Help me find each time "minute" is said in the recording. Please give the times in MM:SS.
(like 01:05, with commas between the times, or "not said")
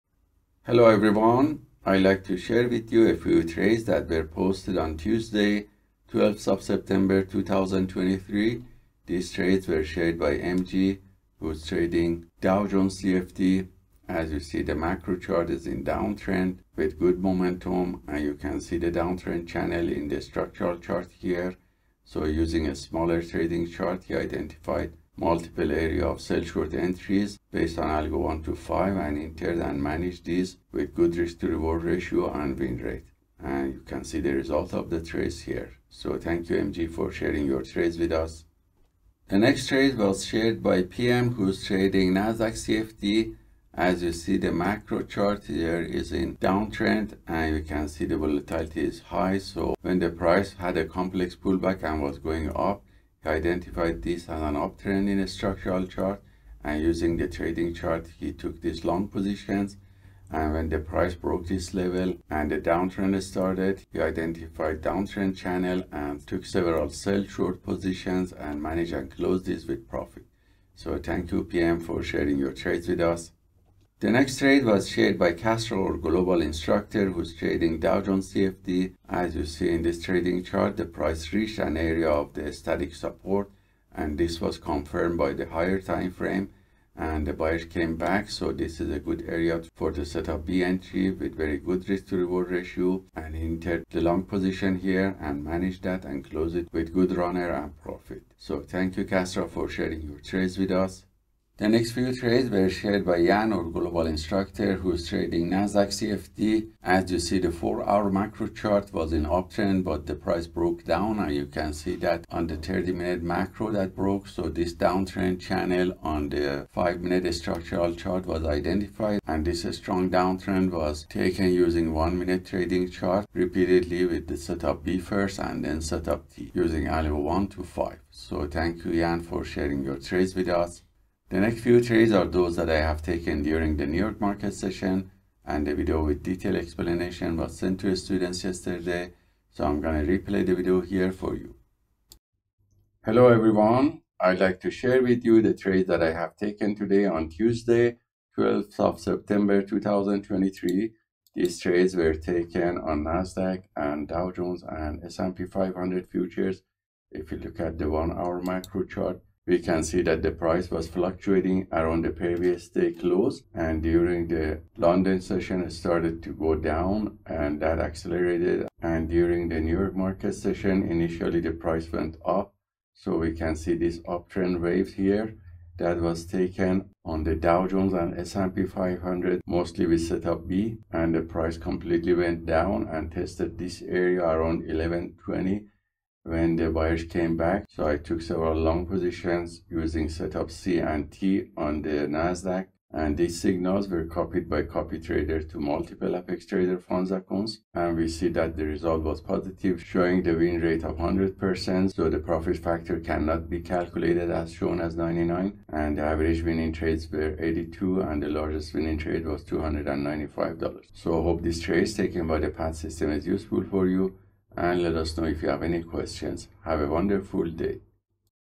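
01:52, 01:56, 02:01.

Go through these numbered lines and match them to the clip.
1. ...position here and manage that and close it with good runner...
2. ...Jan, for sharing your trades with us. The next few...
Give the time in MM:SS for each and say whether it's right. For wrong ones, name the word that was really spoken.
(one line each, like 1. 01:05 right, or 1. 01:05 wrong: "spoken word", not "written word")
1. 01:34 right
2. 02:08 right.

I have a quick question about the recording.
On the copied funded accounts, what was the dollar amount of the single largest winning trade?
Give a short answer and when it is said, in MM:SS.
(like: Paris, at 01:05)
$295, at 03:29.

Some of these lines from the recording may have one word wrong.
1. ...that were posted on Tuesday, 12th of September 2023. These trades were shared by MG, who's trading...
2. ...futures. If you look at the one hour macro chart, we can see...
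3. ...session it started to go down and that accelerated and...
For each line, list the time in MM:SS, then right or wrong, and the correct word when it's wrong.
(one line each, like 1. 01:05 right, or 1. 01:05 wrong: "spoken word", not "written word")
1. 00:03 right
2. 02:36 right
3. 02:45 right.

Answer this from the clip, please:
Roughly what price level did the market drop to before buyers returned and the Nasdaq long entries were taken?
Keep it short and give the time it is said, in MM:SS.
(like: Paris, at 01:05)
1120, at 03:04.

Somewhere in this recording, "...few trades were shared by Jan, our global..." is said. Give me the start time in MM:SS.
01:41.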